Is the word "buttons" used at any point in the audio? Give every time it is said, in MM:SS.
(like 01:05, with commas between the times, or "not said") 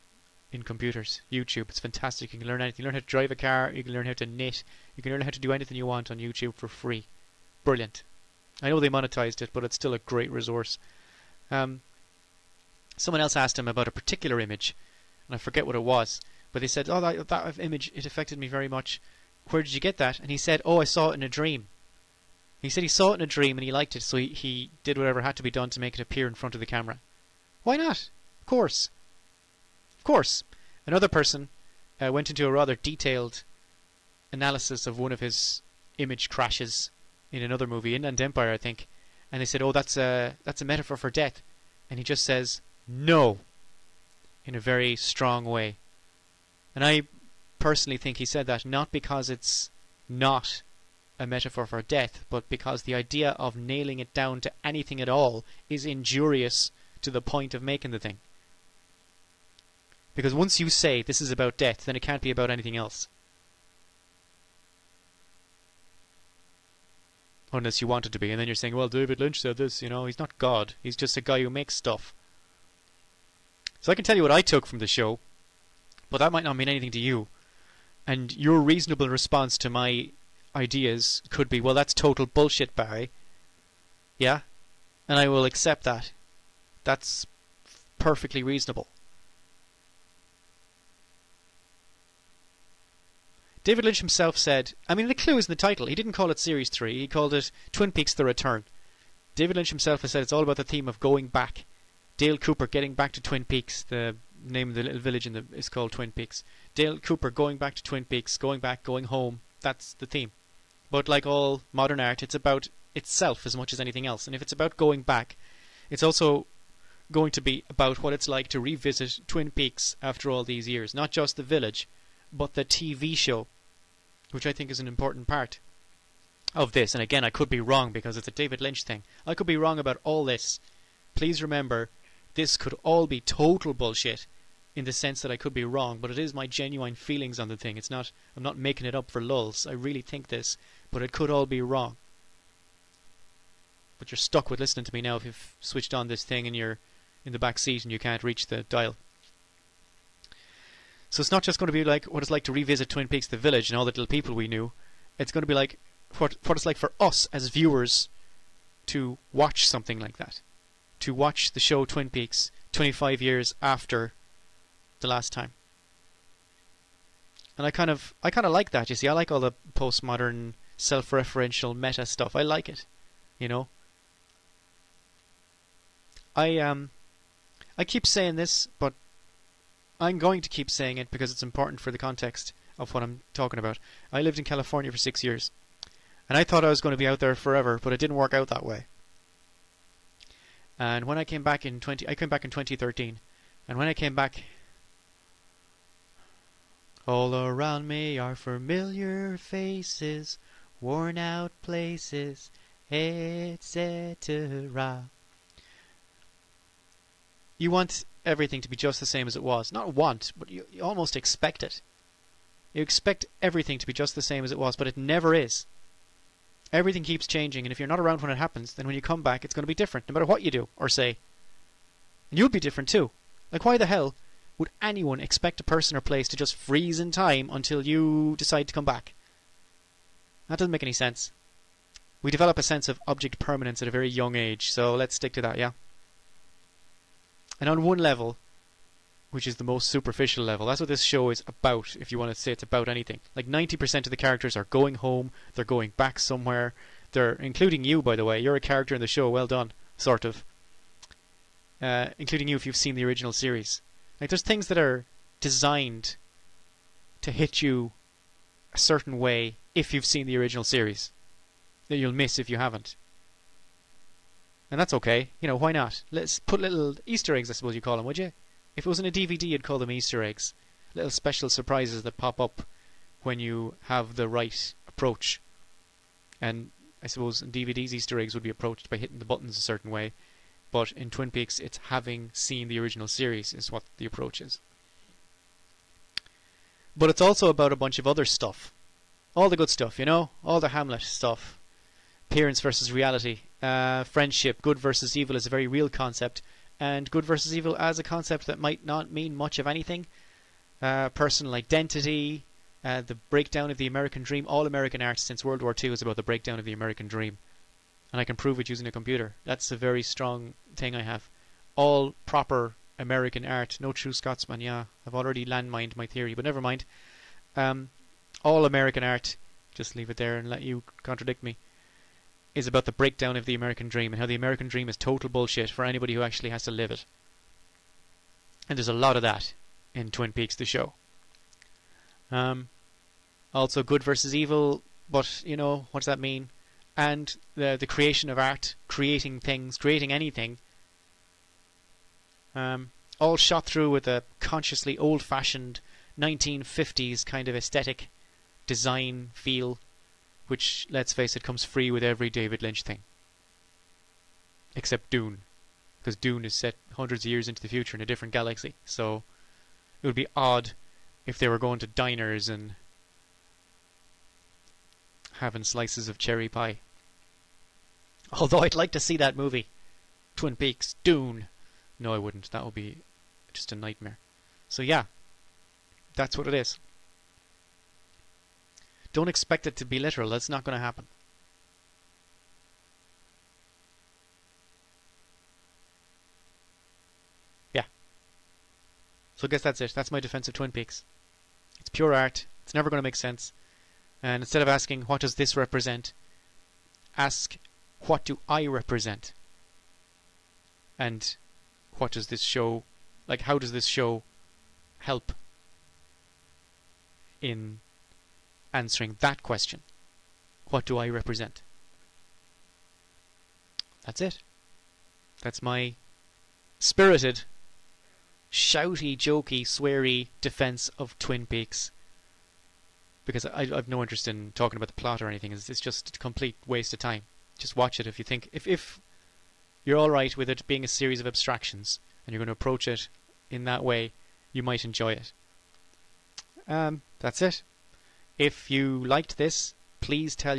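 04:39.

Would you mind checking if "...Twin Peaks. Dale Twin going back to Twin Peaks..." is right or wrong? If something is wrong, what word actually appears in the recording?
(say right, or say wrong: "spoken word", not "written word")
wrong: "Cooper", not "Twin".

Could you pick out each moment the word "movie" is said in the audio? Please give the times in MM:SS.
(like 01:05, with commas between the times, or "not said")
00:37, 06:09.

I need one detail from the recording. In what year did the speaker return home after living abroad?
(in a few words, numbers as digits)
2013.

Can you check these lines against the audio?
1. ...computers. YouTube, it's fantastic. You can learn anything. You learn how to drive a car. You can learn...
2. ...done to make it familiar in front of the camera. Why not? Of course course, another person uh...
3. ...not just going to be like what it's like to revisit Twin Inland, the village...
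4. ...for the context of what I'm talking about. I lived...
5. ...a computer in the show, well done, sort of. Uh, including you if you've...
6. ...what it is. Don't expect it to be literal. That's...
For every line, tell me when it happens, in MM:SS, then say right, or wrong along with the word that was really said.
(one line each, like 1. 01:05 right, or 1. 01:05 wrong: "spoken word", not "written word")
1. 00:00 right
2. 00:25 wrong: "appear", not "familiar"
3. 02:31 wrong: "Peaks", not "Inland"
4. 03:01 right
5. 04:08 wrong: "character", not "computer"
6. 06:16 right.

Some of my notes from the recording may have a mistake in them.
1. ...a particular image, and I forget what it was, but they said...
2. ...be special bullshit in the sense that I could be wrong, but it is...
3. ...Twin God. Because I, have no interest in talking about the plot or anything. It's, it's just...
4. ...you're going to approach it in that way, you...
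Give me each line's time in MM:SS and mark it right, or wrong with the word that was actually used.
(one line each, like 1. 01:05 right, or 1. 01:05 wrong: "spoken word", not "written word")
1. 00:13 right
2. 02:13 wrong: "total", not "special"
3. 07:01 wrong: "Peaks", not "God"
4. 07:12 right.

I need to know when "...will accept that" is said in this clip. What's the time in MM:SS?
01:25.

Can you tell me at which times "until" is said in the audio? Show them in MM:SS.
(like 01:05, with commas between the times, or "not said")
03:47.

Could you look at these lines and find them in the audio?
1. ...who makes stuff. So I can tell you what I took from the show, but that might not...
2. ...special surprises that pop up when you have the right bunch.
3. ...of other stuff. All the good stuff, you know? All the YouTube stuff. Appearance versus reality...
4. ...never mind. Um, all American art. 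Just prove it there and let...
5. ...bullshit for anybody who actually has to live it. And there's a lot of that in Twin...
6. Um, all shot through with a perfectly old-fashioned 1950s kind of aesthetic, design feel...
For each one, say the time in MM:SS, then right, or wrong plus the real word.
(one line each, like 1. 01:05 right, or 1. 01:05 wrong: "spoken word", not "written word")
1. 01:11 right
2. 04:31 wrong: "approach", not "bunch"
3. 04:47 wrong: "Hamlet", not "YouTube"
4. 05:16 wrong: "leave", not "prove"
5. 05:25 right
6. 05:42 wrong: "consciously", not "perfectly".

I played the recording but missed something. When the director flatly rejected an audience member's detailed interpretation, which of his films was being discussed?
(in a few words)
Inland Empire.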